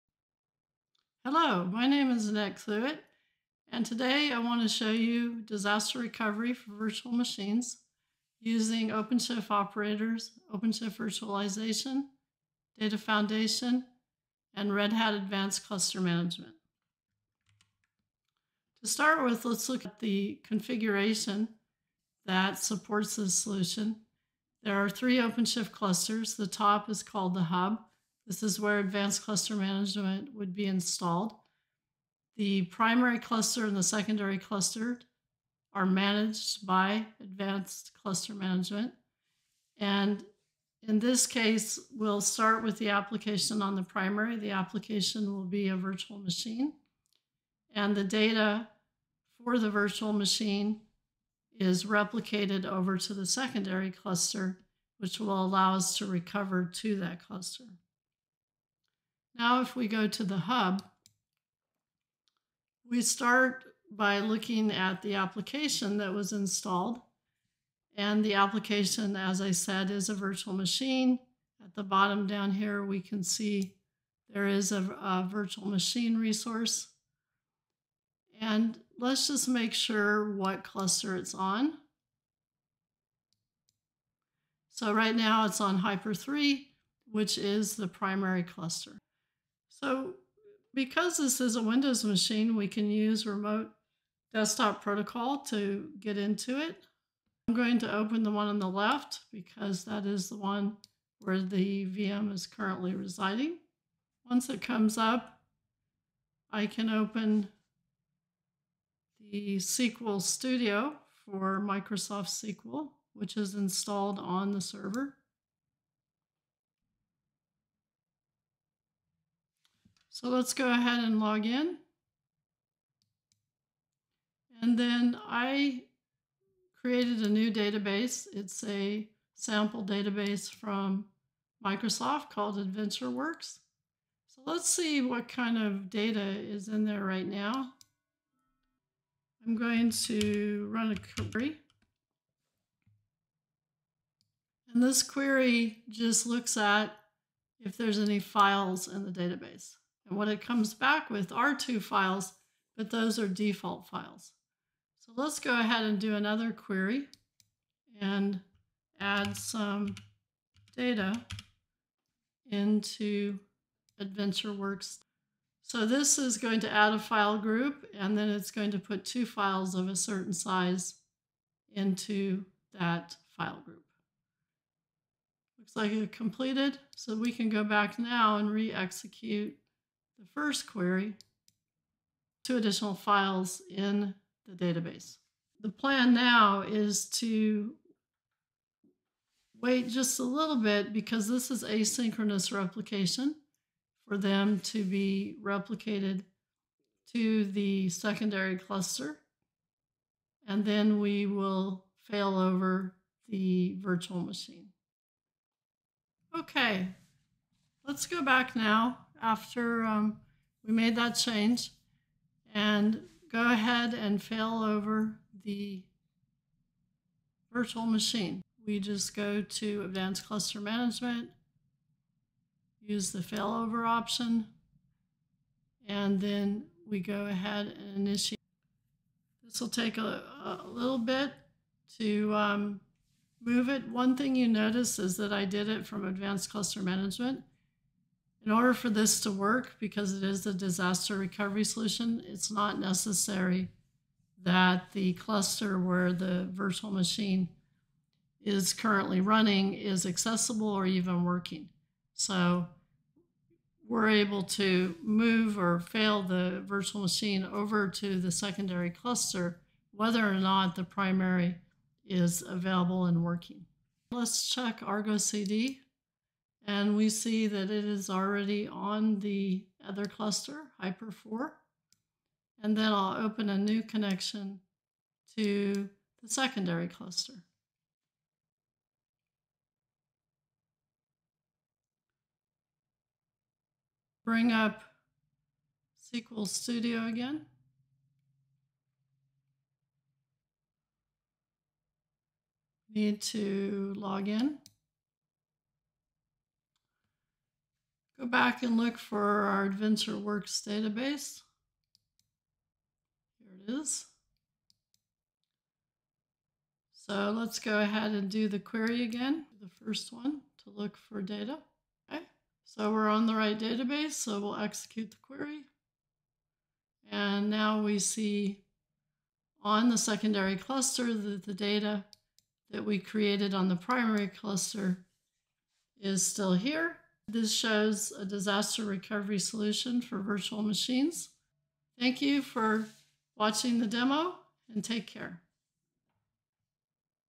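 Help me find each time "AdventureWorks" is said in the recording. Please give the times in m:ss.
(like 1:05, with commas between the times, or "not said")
2:12, 2:44, 4:59.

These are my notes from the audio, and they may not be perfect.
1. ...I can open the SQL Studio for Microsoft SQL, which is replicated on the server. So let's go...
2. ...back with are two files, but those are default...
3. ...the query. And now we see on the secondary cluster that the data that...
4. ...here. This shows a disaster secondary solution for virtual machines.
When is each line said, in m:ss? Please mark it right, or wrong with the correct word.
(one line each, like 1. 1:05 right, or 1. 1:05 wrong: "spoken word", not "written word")
1. 1:46 wrong: "installed", not "replicated"
2. 2:30 right
3. 5:15 right
4. 5:26 wrong: "recovery", not "secondary".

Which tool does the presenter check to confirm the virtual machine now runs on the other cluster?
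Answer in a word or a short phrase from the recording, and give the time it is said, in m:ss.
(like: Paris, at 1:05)
Argo CD, at 4:24.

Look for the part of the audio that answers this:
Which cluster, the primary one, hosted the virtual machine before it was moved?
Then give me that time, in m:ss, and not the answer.
1:25.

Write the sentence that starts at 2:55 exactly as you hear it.
Looks like it completed, so we can go back now and re-execute the first query to additional files in the database.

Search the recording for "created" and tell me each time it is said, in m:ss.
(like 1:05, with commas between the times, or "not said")
2:06, 5:22.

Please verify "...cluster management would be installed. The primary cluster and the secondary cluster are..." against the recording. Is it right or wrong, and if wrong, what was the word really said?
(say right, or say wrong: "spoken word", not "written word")
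right.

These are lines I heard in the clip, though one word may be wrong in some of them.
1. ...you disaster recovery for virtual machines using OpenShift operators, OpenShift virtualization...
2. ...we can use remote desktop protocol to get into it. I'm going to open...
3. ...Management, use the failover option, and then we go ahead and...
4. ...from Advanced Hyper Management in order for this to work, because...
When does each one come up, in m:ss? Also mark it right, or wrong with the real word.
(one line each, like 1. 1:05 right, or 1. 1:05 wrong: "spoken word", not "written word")
1. 0:04 right
2. 1:32 right
3. 3:40 right
4. 3:55 wrong: "Cluster", not "Hyper".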